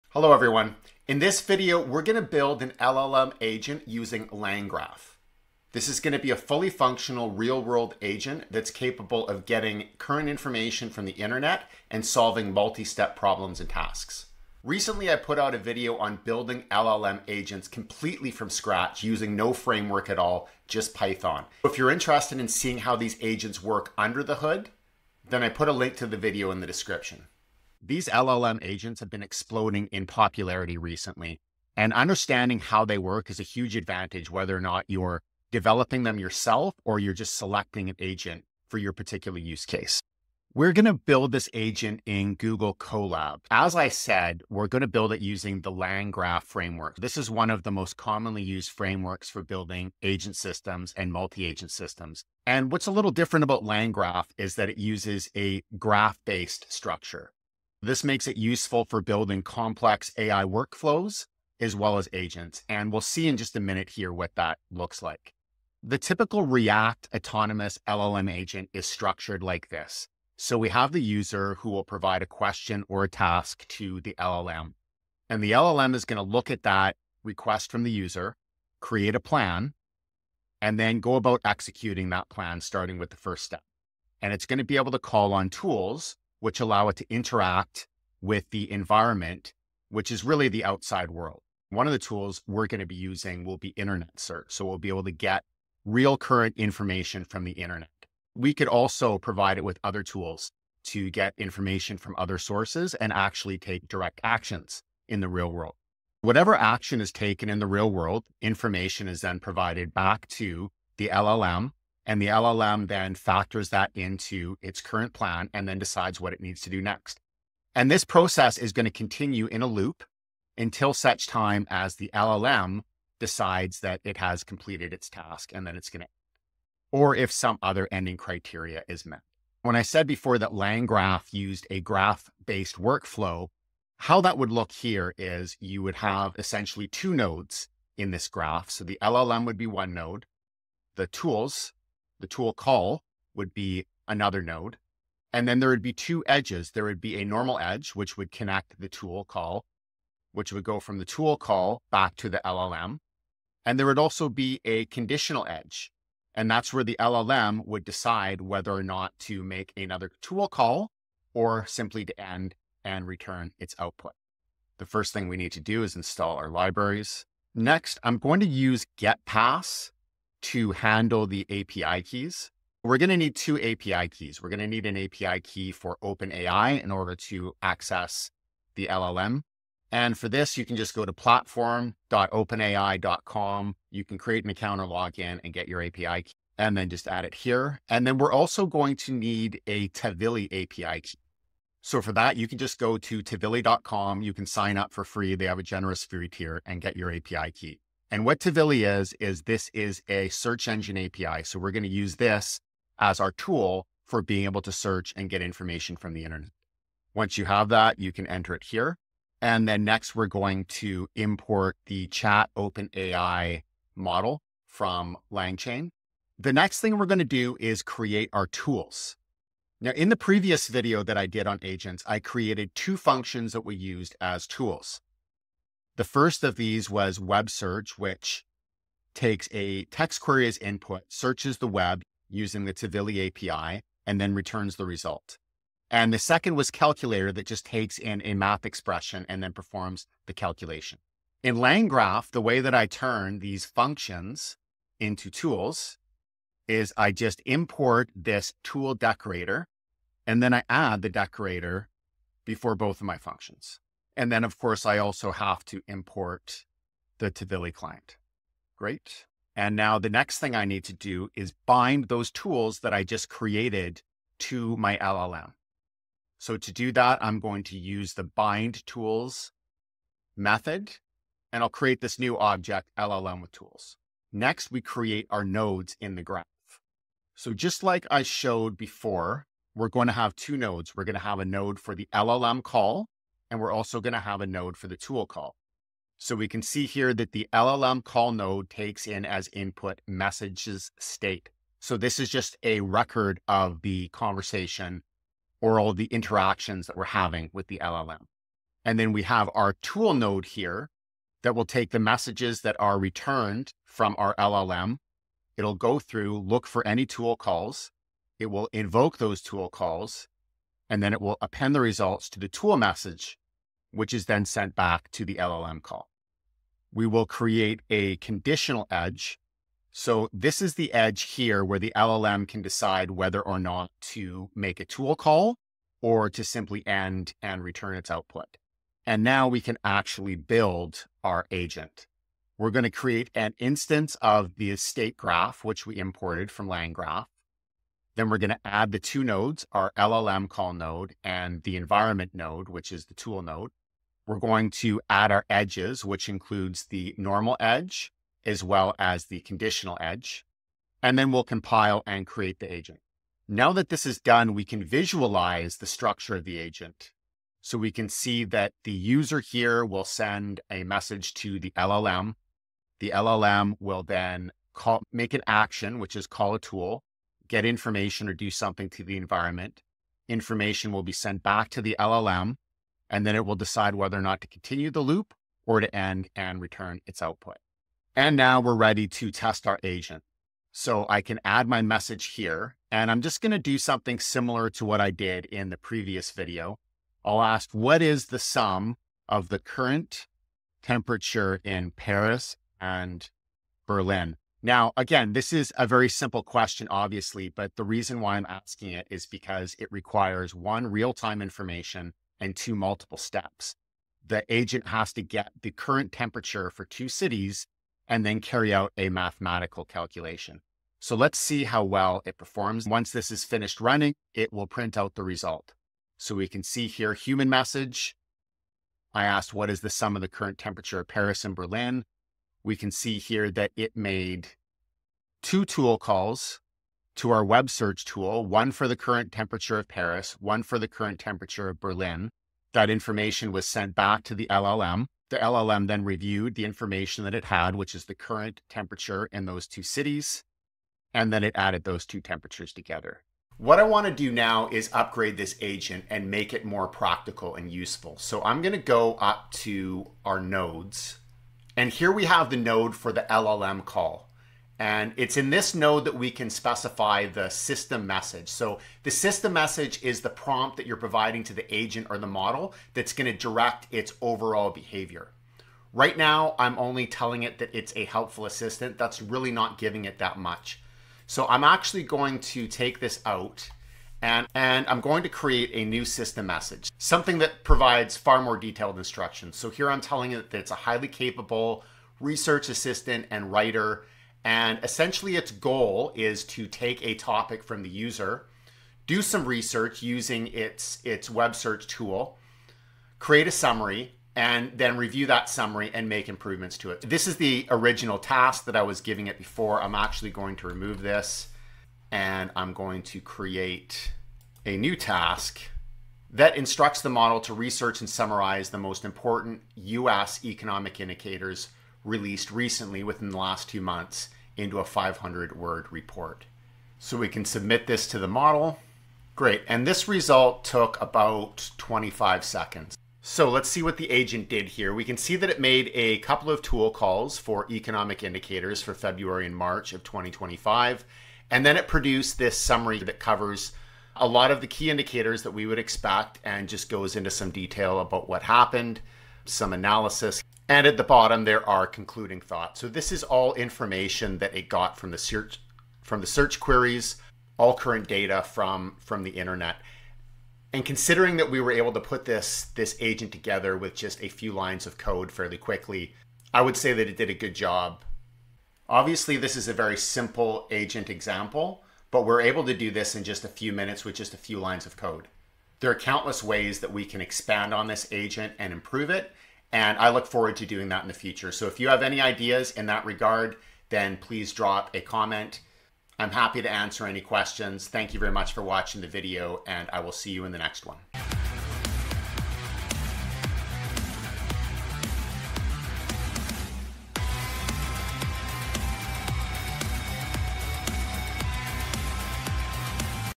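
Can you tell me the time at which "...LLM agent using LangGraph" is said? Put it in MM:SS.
00:02.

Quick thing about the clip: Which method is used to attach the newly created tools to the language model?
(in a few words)
bind tools.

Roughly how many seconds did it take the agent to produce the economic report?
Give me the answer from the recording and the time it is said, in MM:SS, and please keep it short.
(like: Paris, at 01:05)
25, at 08:41.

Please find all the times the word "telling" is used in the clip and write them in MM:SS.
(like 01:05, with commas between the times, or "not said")
07:47, 08:00.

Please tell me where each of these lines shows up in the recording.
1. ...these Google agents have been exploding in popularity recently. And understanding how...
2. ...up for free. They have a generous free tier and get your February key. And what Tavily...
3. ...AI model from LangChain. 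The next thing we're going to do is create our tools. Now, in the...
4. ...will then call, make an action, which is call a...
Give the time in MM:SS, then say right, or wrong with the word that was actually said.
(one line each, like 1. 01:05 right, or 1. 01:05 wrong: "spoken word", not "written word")
1. 00:27 wrong: "LLM", not "Google"
2. 03:14 wrong: "API", not "February"
3. 03:32 right
4. 06:03 right.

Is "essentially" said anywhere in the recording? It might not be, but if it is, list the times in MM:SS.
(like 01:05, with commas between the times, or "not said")
02:16, 08:04.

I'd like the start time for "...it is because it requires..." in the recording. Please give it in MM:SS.
06:38.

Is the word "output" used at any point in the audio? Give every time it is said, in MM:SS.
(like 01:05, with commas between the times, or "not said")
02:43, 05:28, 06:17.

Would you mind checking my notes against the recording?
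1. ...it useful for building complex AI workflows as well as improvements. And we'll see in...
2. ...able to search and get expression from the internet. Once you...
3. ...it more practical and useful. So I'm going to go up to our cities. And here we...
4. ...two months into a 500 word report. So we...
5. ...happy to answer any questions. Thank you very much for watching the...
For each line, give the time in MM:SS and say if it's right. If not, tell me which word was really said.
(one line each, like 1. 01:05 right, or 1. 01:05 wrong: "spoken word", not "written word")
1. 00:58 wrong: "agents", not "improvements"
2. 03:24 wrong: "information", not "expression"
3. 07:26 wrong: "nodes", not "cities"
4. 08:33 right
5. 09:36 right.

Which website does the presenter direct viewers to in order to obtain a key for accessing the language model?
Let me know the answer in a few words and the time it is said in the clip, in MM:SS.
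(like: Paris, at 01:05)
platform.openai.com, at 03:01.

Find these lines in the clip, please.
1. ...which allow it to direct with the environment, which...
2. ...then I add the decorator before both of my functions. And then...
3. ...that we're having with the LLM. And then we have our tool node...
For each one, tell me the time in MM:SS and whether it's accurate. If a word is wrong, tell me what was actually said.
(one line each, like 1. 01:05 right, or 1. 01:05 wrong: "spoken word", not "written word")
1. 01:26 wrong: "interact", not "direct"
2. 04:10 right
3. 04:56 right.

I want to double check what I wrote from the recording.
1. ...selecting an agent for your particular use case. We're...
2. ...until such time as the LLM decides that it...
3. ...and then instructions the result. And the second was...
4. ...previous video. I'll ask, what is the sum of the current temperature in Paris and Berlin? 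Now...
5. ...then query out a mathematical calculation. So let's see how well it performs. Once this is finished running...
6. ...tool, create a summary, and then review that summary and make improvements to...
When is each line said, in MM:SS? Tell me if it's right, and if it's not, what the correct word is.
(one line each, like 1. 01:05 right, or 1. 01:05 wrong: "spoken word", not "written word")
1. 00:37 right
2. 02:00 right
3. 03:54 wrong: "returns", not "instructions"
4. 06:25 right
5. 06:48 wrong: "carry", not "query"
6. 08:11 right.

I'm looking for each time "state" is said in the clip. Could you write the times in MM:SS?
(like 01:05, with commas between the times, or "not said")
04:50, 05:34.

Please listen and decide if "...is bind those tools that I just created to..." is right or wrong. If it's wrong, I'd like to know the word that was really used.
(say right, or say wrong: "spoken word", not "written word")
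right.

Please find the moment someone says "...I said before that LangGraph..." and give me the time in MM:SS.
02:09.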